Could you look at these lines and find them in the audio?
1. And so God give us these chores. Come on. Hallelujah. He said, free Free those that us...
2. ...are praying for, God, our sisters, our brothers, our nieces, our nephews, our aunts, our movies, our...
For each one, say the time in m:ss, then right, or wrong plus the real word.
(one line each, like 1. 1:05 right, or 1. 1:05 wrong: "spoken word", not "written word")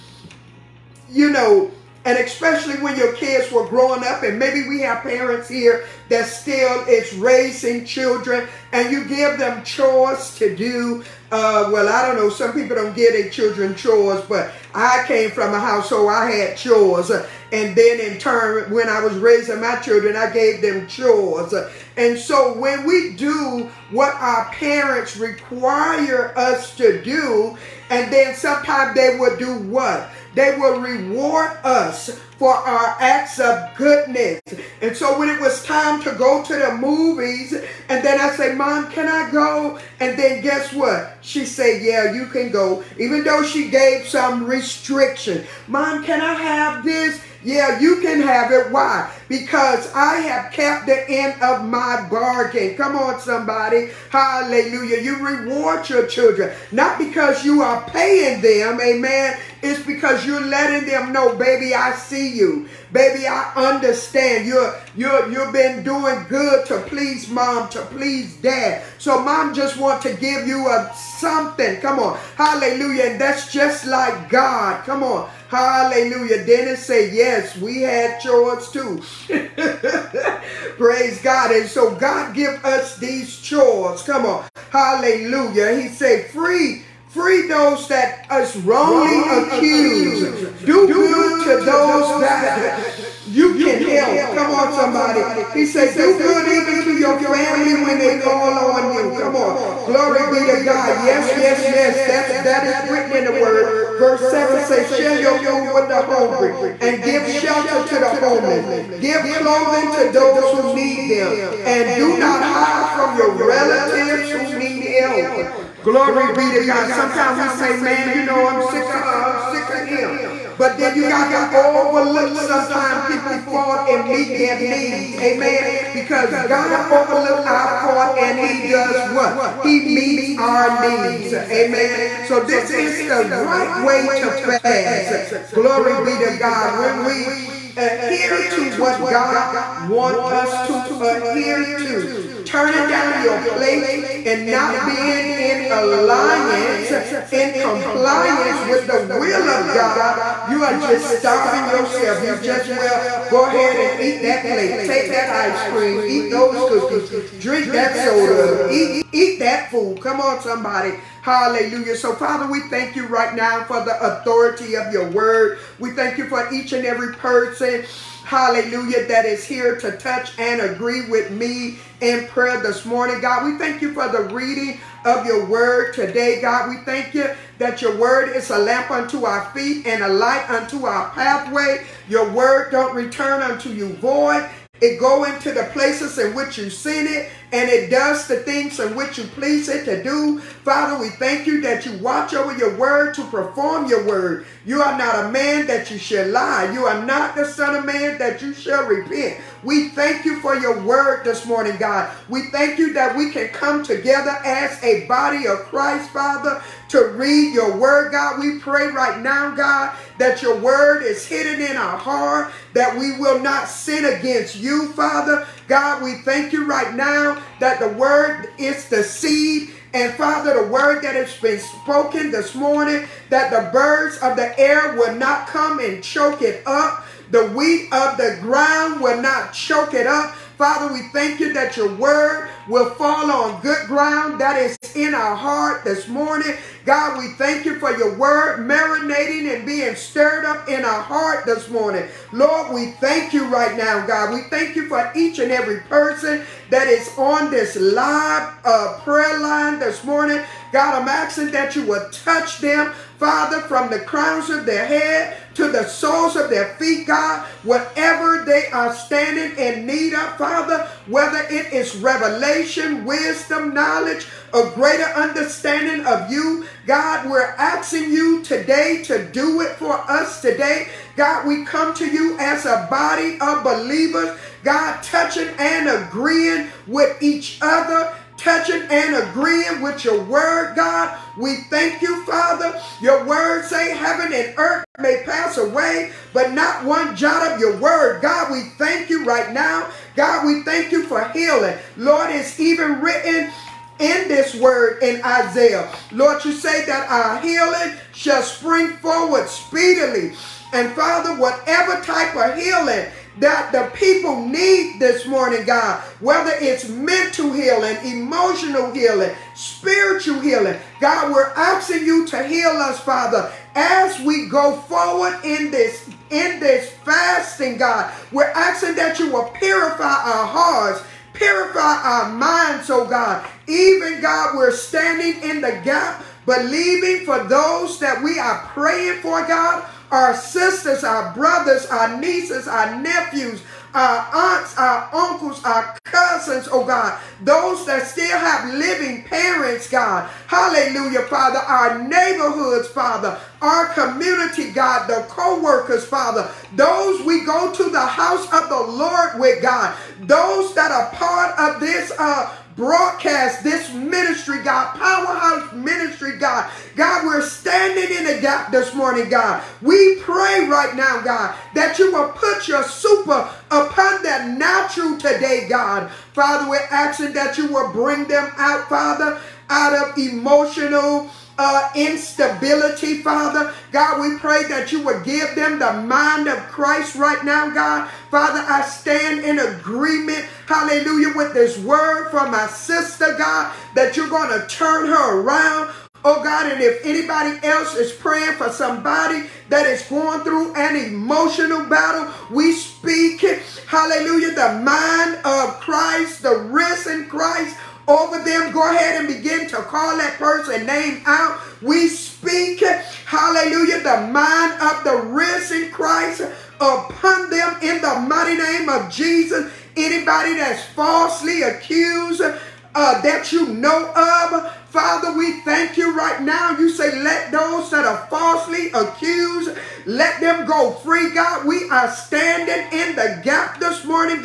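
1. 1:21 right
2. 5:28 wrong: "uncles", not "movies".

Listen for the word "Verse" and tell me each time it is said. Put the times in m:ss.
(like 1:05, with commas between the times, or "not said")
1:43.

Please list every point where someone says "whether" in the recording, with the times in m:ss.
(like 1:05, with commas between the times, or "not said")
4:21, 5:06.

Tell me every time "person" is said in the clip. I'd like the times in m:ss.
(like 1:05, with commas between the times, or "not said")
2:47, 4:05, 6:40.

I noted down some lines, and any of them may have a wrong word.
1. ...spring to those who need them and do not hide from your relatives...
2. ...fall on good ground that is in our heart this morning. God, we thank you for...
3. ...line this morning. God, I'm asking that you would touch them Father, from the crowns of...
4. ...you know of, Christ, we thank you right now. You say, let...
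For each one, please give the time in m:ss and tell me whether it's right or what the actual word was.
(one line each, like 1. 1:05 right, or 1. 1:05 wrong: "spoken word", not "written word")
1. 1:49 wrong: "clothing", not "spring"
2. 3:52 right
3. 4:09 right
4. 6:53 wrong: "Father", not "Christ".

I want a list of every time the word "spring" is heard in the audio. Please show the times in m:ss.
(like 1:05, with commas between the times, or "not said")
4:58.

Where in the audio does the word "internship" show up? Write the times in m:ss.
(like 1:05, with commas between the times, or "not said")
not said.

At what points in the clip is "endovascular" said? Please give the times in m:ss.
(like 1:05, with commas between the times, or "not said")
not said.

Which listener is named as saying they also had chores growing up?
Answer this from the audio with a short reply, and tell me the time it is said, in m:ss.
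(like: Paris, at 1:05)
Dennis, at 1:16.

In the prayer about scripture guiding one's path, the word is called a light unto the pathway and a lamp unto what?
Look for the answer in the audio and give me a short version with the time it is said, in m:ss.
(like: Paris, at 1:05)
our feet, at 2:59.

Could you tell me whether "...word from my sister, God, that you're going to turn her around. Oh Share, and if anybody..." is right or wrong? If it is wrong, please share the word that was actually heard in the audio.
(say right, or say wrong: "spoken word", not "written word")
wrong: "God", not "Share".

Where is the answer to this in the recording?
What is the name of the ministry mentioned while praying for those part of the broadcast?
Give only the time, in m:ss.
5:54.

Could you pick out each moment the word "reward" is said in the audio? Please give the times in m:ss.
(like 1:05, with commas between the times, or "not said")
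0:30, 0:55.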